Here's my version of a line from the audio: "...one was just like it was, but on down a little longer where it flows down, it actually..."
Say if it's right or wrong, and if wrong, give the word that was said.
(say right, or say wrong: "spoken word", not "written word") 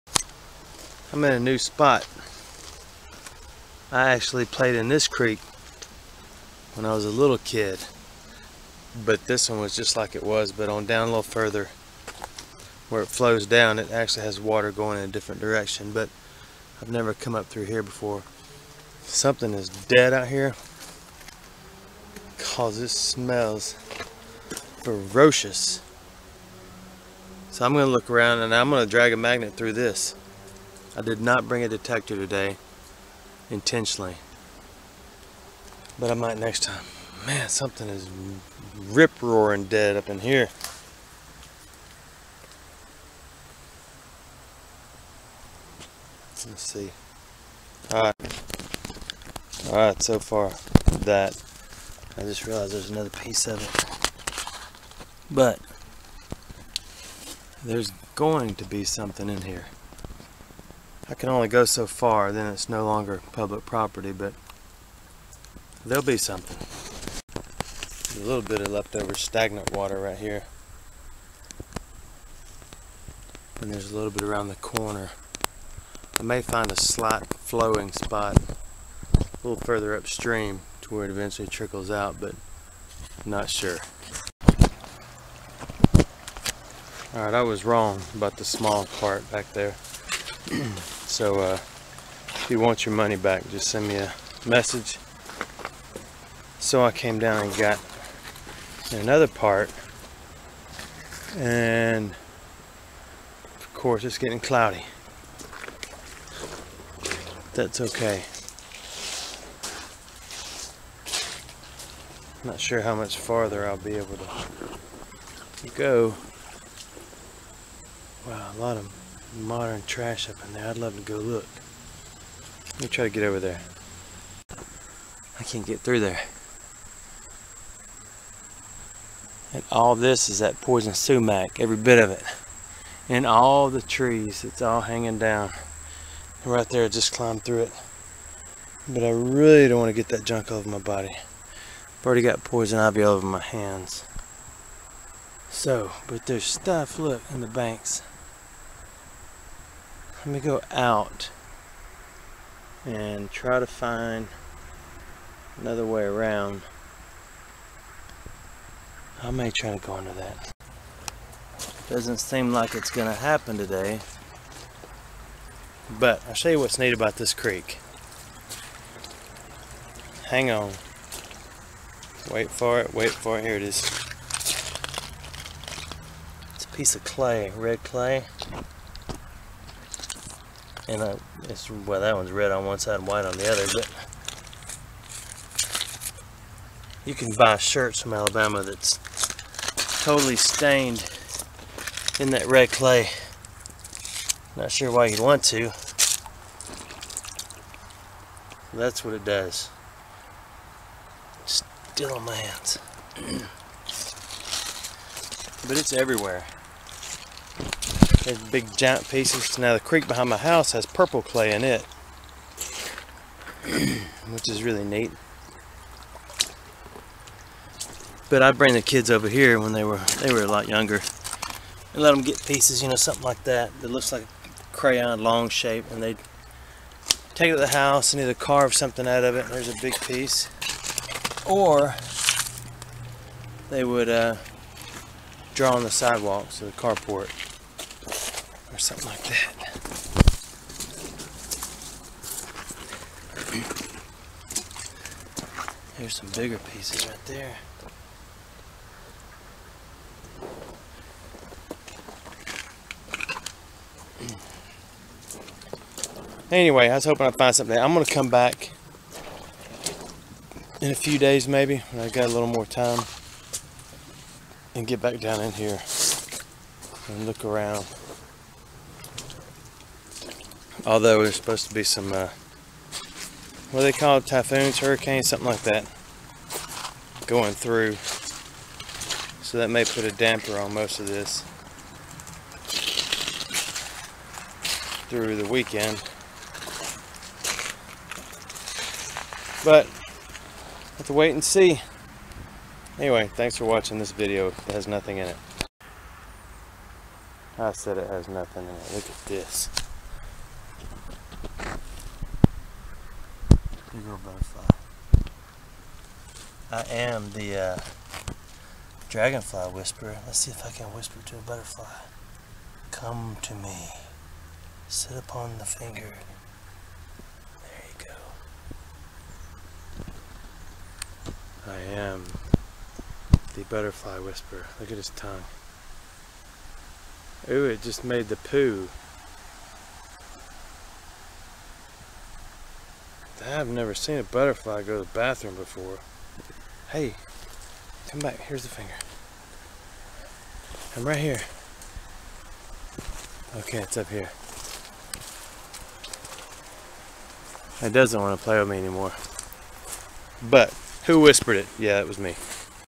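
wrong: "further", not "longer".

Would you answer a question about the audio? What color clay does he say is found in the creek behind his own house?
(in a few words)
purple.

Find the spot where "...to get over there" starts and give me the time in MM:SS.
02:03.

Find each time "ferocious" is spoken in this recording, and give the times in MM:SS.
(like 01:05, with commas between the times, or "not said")
00:24.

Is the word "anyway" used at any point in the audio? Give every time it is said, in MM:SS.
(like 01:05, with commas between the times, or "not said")
04:16, 04:52.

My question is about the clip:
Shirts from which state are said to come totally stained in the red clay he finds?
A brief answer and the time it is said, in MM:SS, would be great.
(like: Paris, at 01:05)
Alabama, at 03:08.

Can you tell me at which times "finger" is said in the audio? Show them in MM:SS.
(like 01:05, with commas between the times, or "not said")
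05:15, 05:38.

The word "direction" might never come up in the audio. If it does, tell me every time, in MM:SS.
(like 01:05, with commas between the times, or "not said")
00:15.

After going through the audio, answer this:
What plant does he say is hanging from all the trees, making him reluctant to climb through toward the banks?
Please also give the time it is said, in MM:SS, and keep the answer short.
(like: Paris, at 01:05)
poison sumac, at 02:10.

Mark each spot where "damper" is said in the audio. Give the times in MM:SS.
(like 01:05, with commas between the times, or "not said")
04:40.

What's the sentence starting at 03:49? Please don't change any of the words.
there's a big piece, or they would uh, draw on the sidewalks or the carport something like that.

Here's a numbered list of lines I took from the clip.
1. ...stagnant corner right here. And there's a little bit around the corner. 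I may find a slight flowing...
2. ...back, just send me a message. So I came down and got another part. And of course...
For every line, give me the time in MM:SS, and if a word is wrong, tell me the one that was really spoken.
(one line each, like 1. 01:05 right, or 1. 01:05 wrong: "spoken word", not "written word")
1. 01:09 wrong: "water", not "corner"
2. 01:33 right.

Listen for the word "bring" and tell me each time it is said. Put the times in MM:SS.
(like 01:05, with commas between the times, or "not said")
00:31, 03:38.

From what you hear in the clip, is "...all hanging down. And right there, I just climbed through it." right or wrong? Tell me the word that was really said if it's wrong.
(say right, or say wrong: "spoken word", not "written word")
right.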